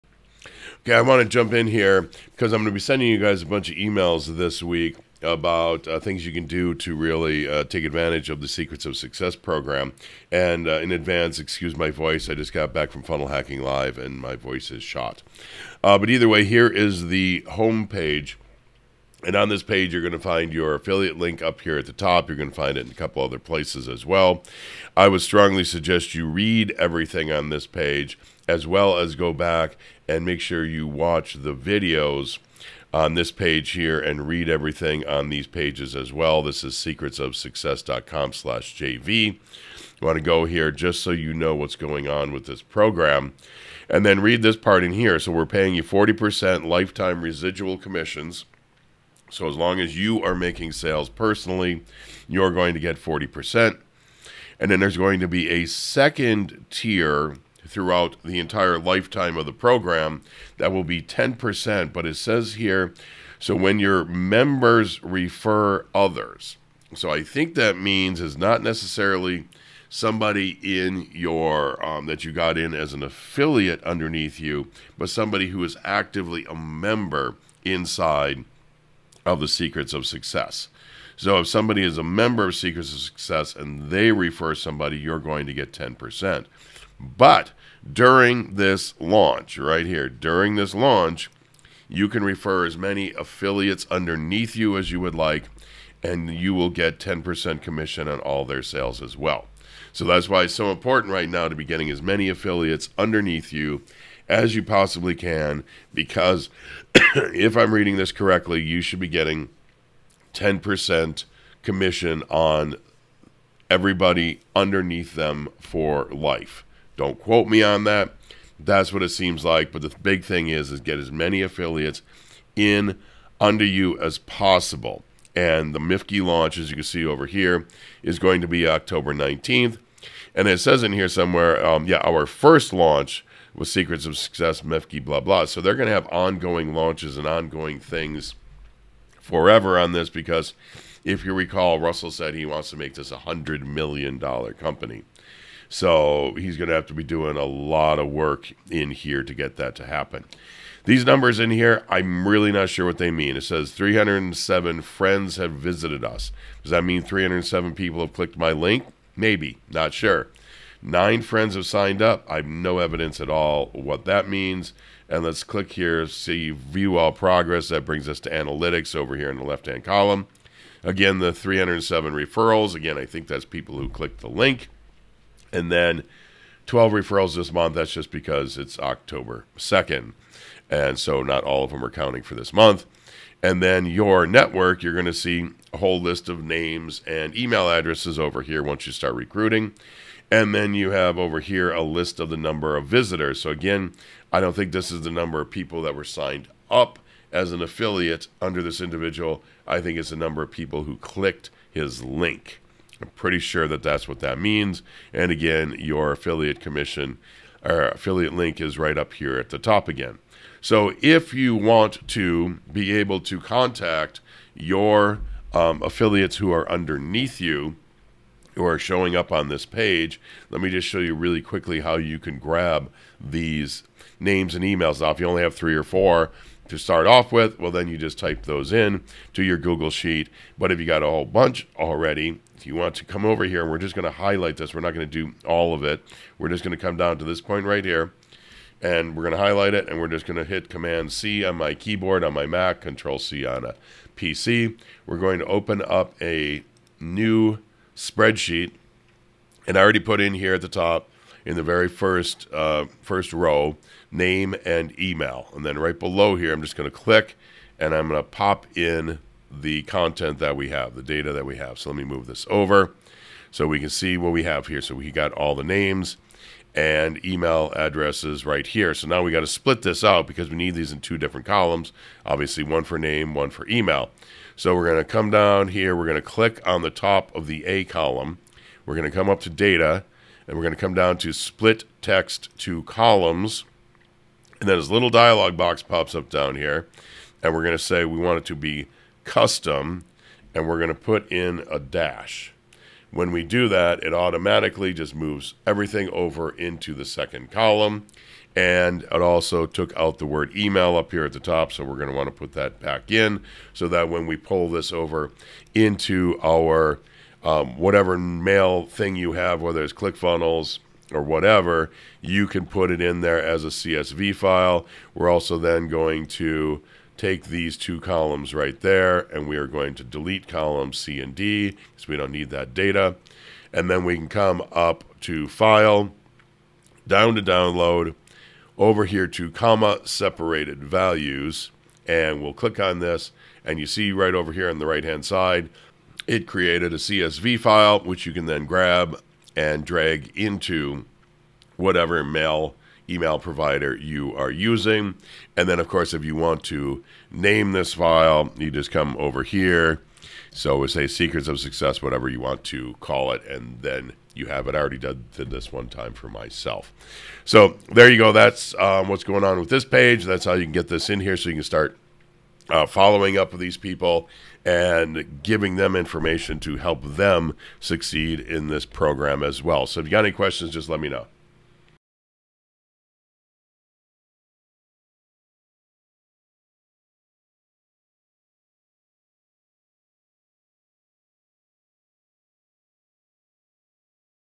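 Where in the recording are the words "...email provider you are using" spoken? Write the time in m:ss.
5:43.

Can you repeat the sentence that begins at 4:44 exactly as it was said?
And then this little dialog box pops up down here.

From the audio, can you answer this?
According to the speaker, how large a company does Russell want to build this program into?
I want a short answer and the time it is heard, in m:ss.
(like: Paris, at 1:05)
$100 million, at 2:23.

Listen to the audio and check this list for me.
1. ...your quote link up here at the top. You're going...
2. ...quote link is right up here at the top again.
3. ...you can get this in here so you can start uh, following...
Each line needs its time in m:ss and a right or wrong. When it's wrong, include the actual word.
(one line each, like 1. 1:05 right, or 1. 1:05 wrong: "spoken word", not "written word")
1. 0:20 wrong: "affiliate", not "quote"
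2. 3:27 wrong: "affiliate", not "quote"
3. 6:00 right.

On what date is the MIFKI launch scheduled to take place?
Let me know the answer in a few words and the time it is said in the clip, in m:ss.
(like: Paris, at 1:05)
October 19th, at 2:08.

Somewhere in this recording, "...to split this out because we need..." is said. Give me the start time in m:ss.
4:29.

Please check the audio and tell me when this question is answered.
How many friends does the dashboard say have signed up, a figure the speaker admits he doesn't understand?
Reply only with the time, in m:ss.
2:40.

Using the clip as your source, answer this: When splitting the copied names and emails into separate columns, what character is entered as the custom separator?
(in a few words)
a dash.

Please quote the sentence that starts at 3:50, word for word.
But if you got a whole bunch already, if you want to come over here, and we're just going to highlight this.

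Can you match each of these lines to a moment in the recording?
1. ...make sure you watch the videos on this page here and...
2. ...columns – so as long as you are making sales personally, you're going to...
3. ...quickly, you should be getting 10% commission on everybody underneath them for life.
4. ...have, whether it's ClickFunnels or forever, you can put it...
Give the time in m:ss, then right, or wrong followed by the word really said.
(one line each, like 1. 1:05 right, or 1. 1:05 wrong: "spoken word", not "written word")
1. 0:30 right
2. 0:47 wrong: "commissions", not "columns"
3. 1:48 wrong: "correctly", not "quickly"
4. 5:09 wrong: "whatever", not "forever".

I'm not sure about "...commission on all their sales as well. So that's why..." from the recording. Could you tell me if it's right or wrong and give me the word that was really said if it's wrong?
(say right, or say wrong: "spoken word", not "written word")
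right.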